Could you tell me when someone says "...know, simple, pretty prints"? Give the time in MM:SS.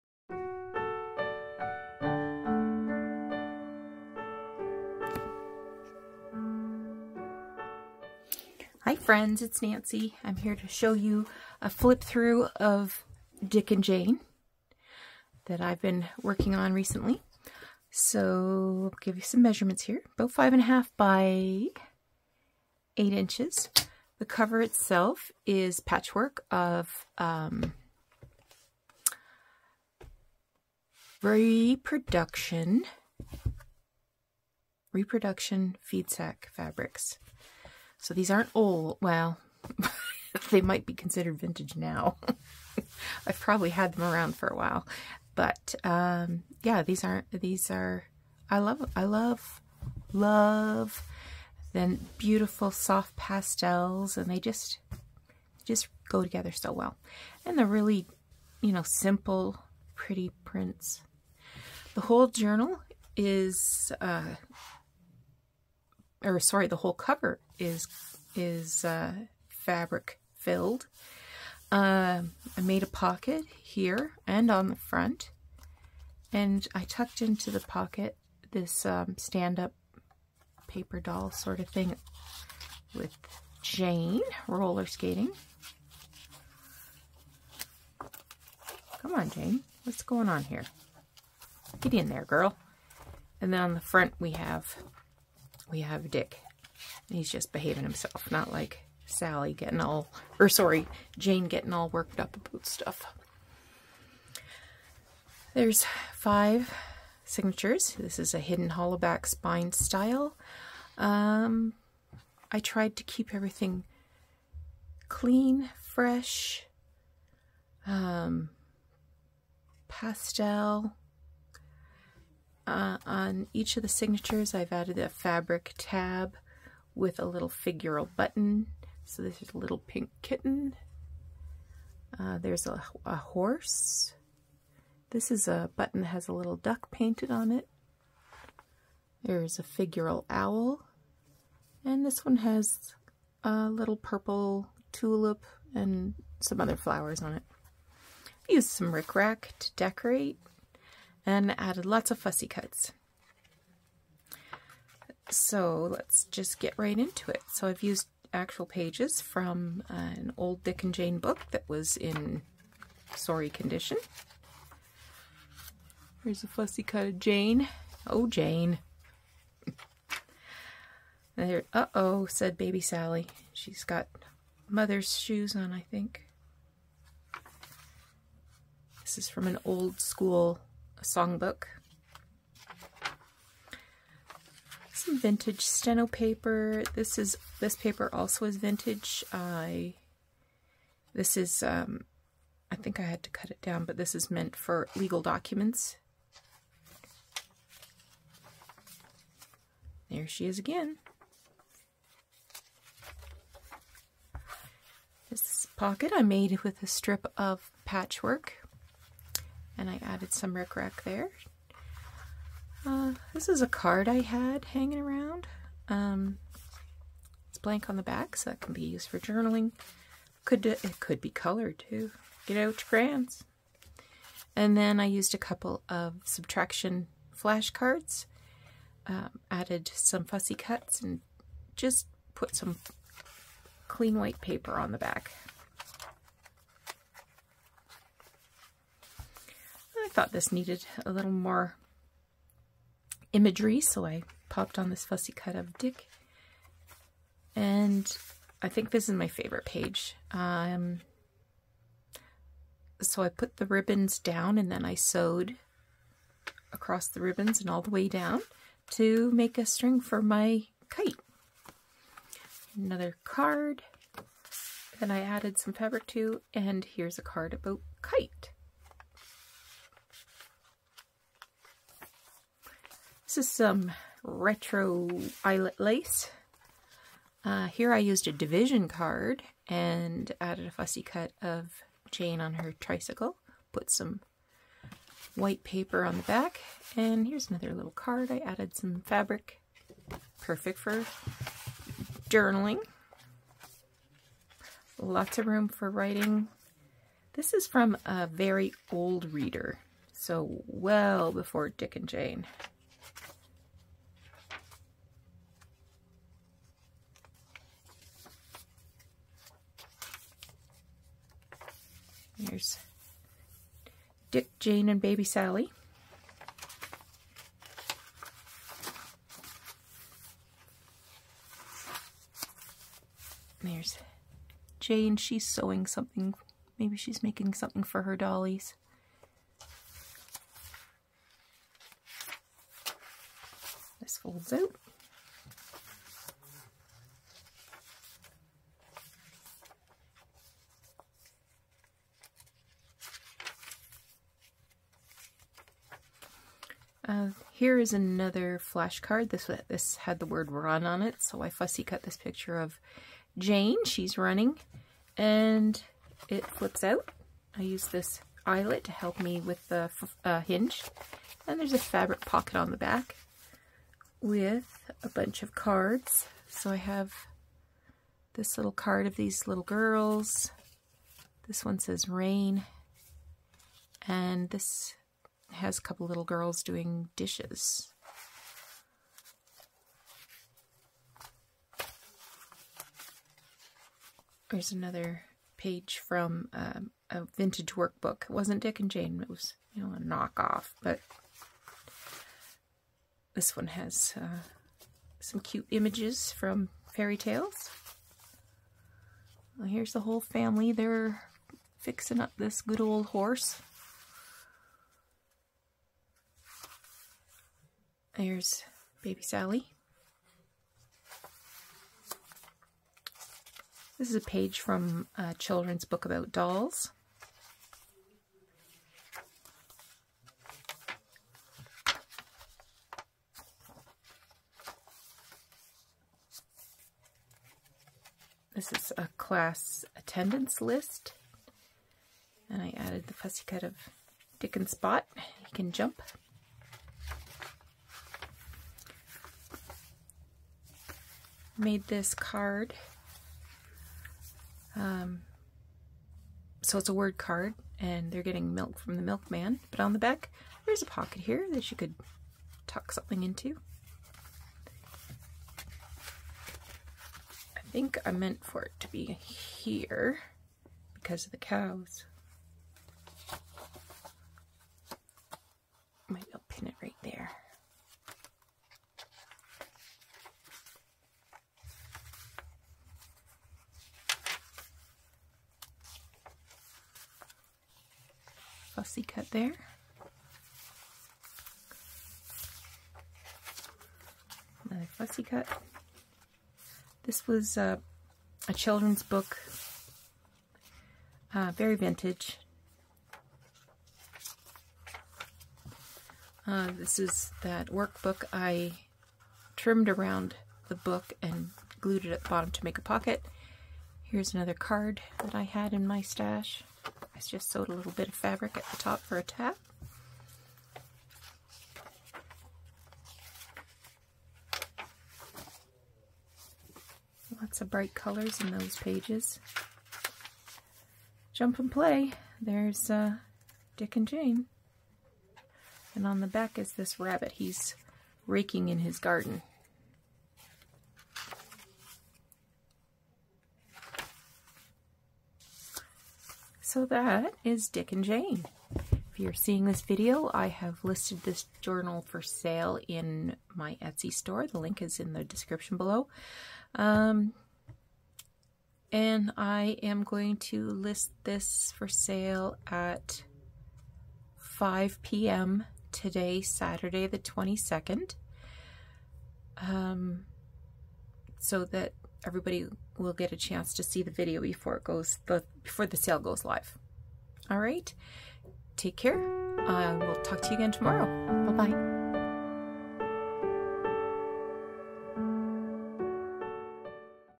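00:58.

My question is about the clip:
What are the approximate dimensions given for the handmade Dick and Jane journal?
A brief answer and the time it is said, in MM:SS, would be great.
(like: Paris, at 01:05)
5.5 by 8 inches, at 00:20.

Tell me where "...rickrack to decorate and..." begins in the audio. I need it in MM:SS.
02:28.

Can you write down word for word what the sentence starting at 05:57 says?
I use this eyelet to help me with the uh, hinge.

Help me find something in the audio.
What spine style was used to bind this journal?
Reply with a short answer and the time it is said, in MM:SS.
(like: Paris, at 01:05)
Hidden hollowback, at 01:48.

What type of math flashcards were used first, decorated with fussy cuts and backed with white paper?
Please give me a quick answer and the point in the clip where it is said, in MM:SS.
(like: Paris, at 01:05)
Subtraction, at 03:46.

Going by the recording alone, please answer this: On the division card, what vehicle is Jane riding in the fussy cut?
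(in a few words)
Tricycle.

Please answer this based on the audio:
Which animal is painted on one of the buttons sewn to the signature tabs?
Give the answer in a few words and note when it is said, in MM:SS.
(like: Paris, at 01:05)
Duck, at 02:16.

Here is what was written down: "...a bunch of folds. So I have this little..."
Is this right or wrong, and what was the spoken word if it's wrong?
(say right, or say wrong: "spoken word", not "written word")
wrong: "cards", not "folds".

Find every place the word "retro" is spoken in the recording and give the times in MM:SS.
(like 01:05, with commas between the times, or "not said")
04:34.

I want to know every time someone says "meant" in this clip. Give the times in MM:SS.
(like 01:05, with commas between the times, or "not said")
03:14, 07:38.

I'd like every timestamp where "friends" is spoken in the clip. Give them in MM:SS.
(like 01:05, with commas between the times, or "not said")
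00:08.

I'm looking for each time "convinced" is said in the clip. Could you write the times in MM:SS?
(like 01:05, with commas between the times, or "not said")
not said.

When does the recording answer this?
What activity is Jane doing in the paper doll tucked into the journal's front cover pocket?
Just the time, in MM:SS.
01:24.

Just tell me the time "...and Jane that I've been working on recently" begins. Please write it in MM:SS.
00:13.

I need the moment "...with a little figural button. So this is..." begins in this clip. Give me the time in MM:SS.
02:06.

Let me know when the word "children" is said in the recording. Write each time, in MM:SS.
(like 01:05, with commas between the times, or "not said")
06:55, 08:08.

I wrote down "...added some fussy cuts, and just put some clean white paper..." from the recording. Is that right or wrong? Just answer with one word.
right.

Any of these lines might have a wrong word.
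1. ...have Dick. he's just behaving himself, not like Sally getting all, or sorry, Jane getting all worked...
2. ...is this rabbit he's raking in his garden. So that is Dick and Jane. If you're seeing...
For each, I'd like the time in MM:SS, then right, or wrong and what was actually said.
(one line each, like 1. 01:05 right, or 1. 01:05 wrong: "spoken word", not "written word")
1. 01:35 right
2. 08:46 right.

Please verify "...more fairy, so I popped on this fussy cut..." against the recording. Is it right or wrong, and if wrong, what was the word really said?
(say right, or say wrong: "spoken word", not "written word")
wrong: "imagery", not "fairy".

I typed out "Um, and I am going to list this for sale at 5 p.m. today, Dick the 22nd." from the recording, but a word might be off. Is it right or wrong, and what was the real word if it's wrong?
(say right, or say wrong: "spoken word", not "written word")
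wrong: "Saturday", not "Dick".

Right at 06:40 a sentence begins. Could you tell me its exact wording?
They're fixing up this good old horse.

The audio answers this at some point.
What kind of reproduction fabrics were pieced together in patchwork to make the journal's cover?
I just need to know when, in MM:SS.
00:35.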